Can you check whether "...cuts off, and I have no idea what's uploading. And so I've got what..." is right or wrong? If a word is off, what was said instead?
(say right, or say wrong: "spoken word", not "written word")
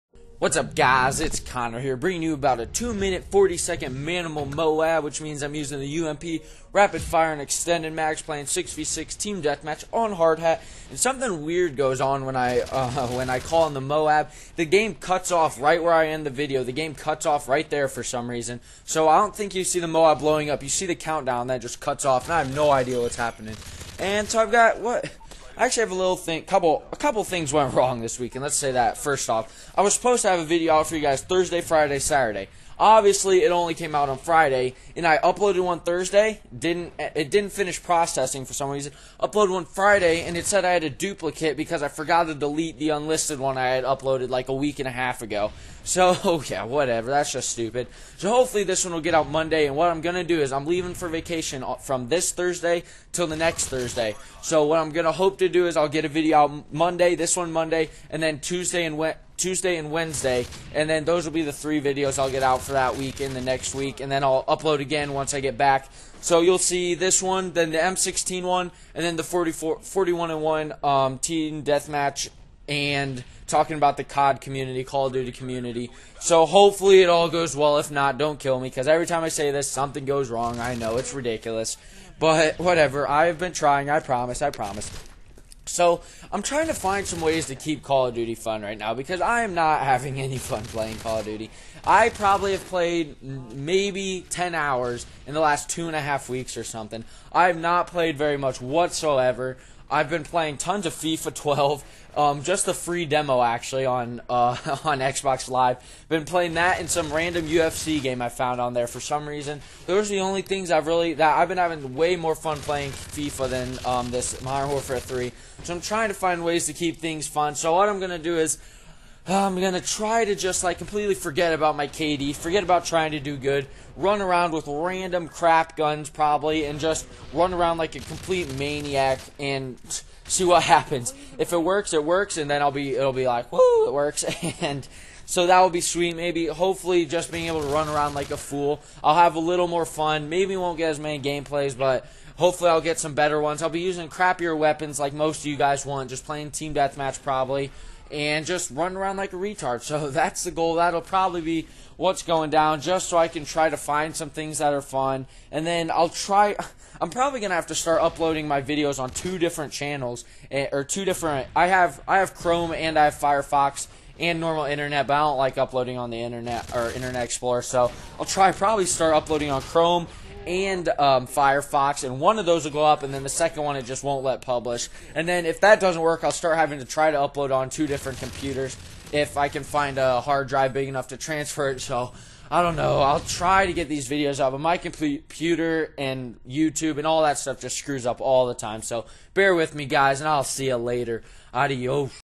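wrong: "happening", not "uploading".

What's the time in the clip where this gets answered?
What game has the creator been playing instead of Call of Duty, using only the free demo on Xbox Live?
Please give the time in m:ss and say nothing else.
1:40.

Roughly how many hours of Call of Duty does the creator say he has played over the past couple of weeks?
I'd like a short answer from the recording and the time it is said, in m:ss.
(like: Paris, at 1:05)
10 hours, at 1:34.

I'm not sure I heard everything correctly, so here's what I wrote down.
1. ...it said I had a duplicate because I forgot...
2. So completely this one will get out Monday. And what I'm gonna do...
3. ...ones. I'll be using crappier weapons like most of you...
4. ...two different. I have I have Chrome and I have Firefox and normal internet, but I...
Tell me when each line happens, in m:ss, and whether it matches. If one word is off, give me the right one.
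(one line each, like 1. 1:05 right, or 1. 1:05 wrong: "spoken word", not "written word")
1. 0:40 right
2. 0:48 wrong: "hopefully", not "completely"
3. 2:23 right
4. 2:40 right.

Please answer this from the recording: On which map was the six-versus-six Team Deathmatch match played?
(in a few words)
Hard Hat.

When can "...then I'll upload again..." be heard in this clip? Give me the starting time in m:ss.
1:04.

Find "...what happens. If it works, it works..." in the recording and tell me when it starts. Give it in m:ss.
2:10.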